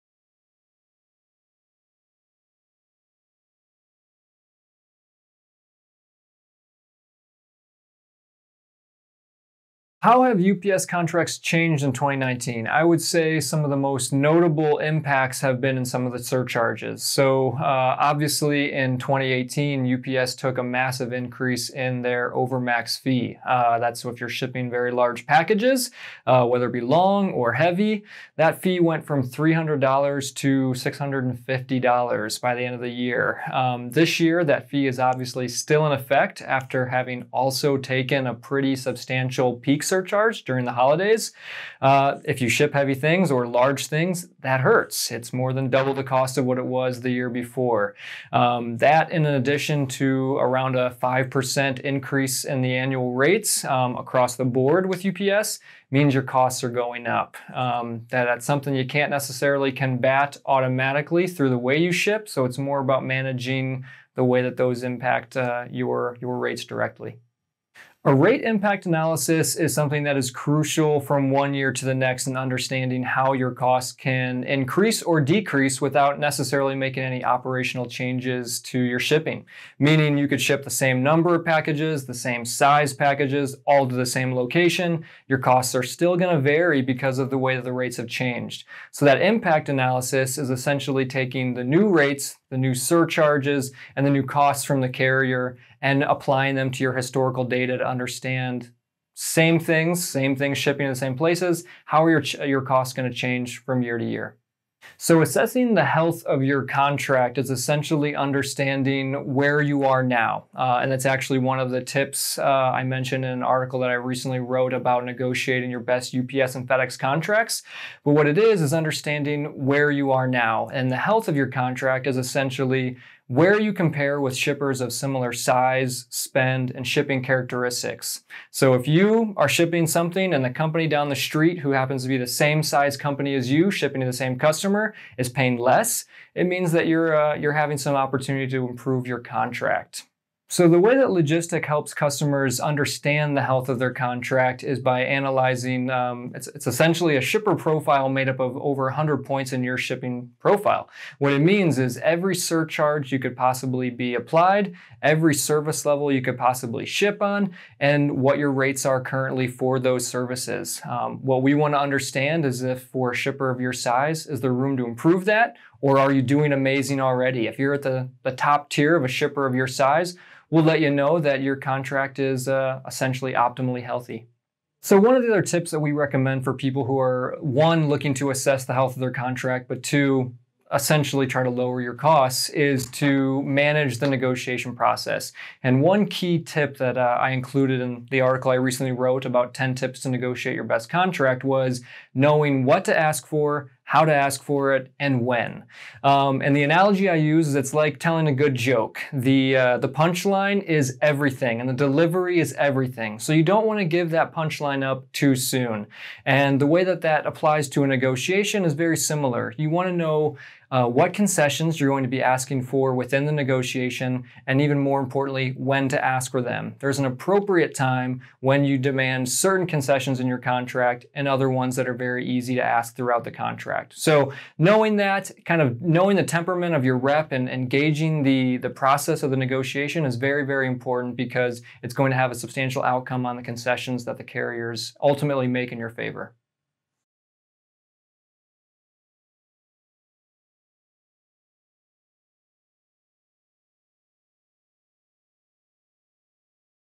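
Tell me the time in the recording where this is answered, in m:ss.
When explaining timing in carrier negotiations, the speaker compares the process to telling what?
3:18.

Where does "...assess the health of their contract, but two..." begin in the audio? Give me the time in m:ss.
2:58.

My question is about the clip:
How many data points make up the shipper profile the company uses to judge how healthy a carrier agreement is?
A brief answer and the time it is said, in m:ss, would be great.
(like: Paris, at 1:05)
over 100, at 2:28.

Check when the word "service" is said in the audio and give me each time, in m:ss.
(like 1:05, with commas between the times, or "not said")
2:35, 2:40.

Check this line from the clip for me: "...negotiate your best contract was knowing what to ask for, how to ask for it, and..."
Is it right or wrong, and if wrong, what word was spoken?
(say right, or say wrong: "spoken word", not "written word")
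right.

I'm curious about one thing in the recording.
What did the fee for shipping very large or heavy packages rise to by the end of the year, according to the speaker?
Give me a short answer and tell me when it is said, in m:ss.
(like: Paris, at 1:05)
$650, at 0:30.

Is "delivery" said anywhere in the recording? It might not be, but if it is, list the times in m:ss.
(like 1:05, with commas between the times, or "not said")
3:21.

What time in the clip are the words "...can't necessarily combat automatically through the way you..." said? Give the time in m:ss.
0:58.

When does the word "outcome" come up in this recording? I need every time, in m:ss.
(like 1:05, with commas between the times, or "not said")
3:52.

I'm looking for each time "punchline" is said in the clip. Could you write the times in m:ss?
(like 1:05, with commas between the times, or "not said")
3:19, 3:24.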